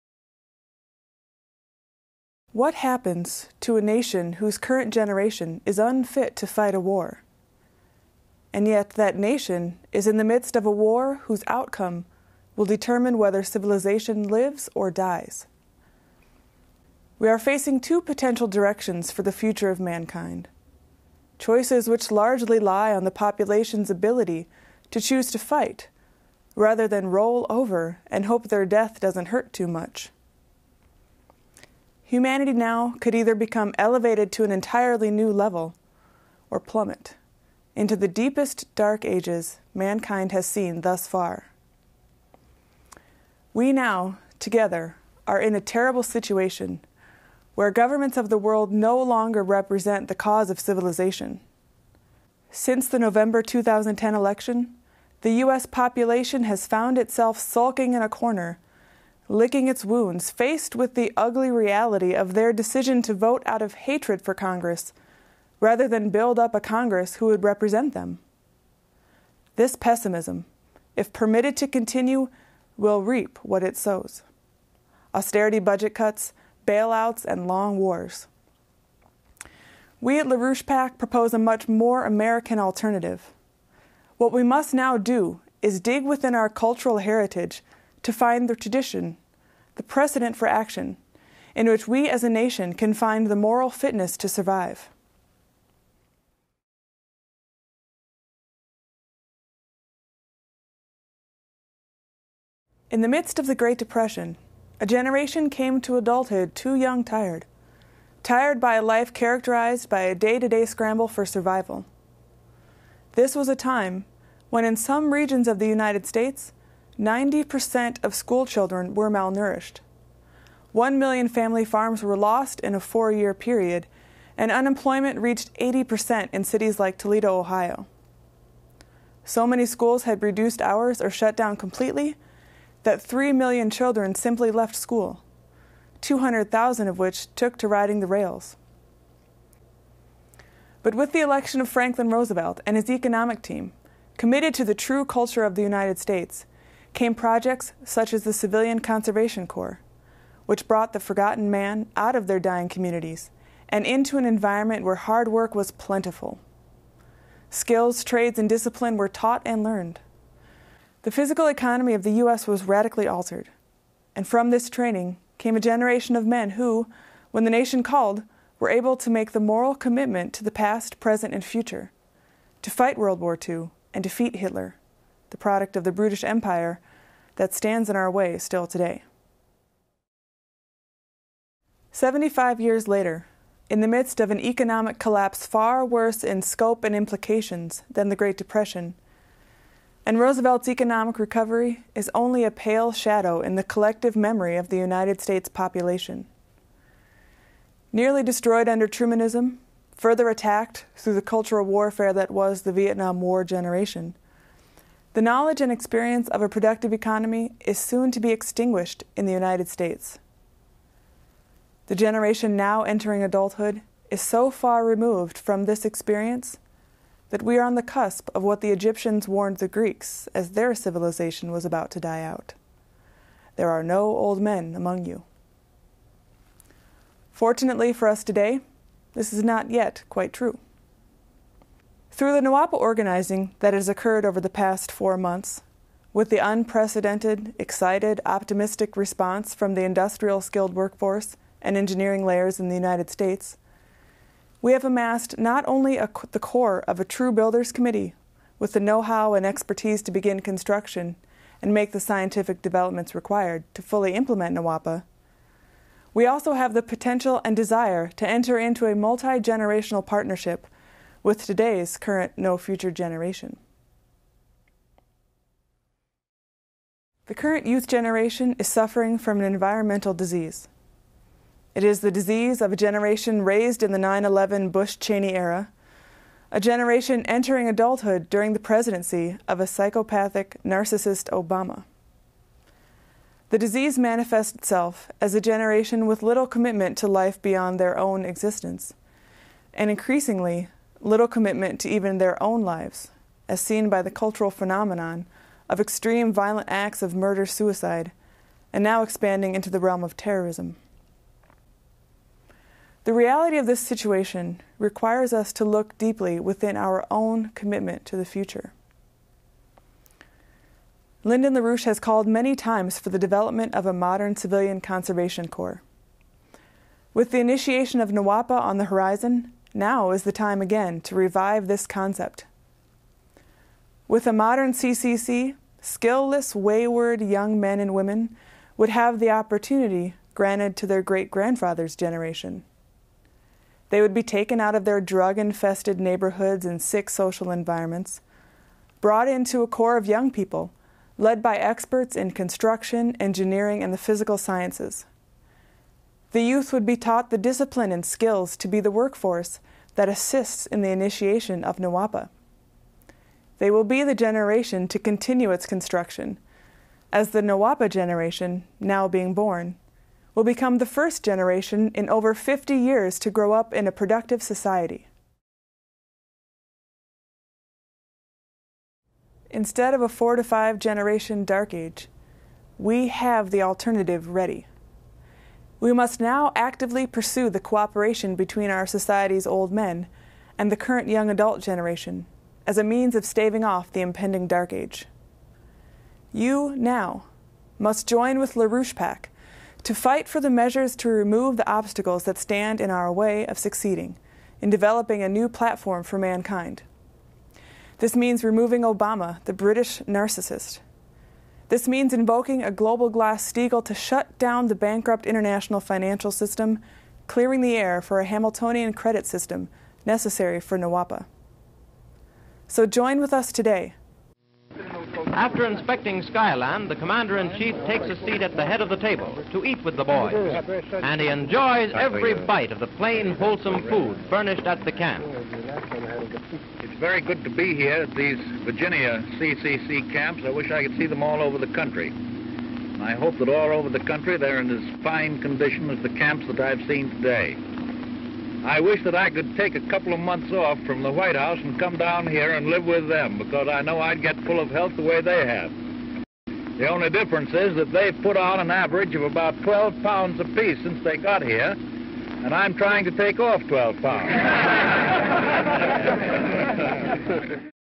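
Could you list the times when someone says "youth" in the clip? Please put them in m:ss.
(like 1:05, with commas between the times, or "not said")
4:27, 5:46.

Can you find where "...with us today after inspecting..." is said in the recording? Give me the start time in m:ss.
6:53.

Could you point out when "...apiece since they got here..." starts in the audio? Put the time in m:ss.
7:30.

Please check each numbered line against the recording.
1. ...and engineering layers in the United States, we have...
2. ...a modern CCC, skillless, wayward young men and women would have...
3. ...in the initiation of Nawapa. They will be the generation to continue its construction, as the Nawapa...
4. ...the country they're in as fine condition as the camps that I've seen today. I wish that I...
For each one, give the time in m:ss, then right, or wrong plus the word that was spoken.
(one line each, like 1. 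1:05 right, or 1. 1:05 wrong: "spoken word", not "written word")
1. 4:01 right
2. 5:24 right
3. 5:50 right
4. 7:13 right.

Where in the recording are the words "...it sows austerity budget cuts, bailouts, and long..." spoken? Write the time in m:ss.
1:13.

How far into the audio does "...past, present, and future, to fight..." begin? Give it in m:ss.
2:50.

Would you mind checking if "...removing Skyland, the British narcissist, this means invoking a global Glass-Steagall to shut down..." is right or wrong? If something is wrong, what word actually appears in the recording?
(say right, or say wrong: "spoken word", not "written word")
wrong: "Obama", not "Skyland".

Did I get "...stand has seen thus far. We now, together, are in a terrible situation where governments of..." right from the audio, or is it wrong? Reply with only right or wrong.
wrong.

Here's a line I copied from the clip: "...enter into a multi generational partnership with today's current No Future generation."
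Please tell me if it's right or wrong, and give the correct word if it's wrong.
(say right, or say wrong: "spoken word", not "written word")
right.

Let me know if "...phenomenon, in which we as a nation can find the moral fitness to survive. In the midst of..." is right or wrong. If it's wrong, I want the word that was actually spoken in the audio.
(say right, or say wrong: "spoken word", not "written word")
wrong: "action", not "phenomenon".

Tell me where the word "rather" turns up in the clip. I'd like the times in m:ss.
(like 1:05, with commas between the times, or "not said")
0:26, 1:05.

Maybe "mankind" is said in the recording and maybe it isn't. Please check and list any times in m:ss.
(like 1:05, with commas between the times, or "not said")
0:19, 0:39, 6:36.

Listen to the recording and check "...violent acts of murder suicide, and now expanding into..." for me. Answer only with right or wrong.
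right.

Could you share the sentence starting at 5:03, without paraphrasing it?
The reality of this situation requires us to look deeply within our own commitment to the future.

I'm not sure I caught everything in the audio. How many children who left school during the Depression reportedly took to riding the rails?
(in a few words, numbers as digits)
200,000.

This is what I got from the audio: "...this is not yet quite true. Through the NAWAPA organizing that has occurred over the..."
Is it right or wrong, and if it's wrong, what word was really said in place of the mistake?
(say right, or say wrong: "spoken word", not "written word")
right.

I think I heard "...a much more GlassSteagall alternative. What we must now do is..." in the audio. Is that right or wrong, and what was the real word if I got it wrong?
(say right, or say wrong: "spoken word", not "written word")
wrong: "American", not "GlassSteagall".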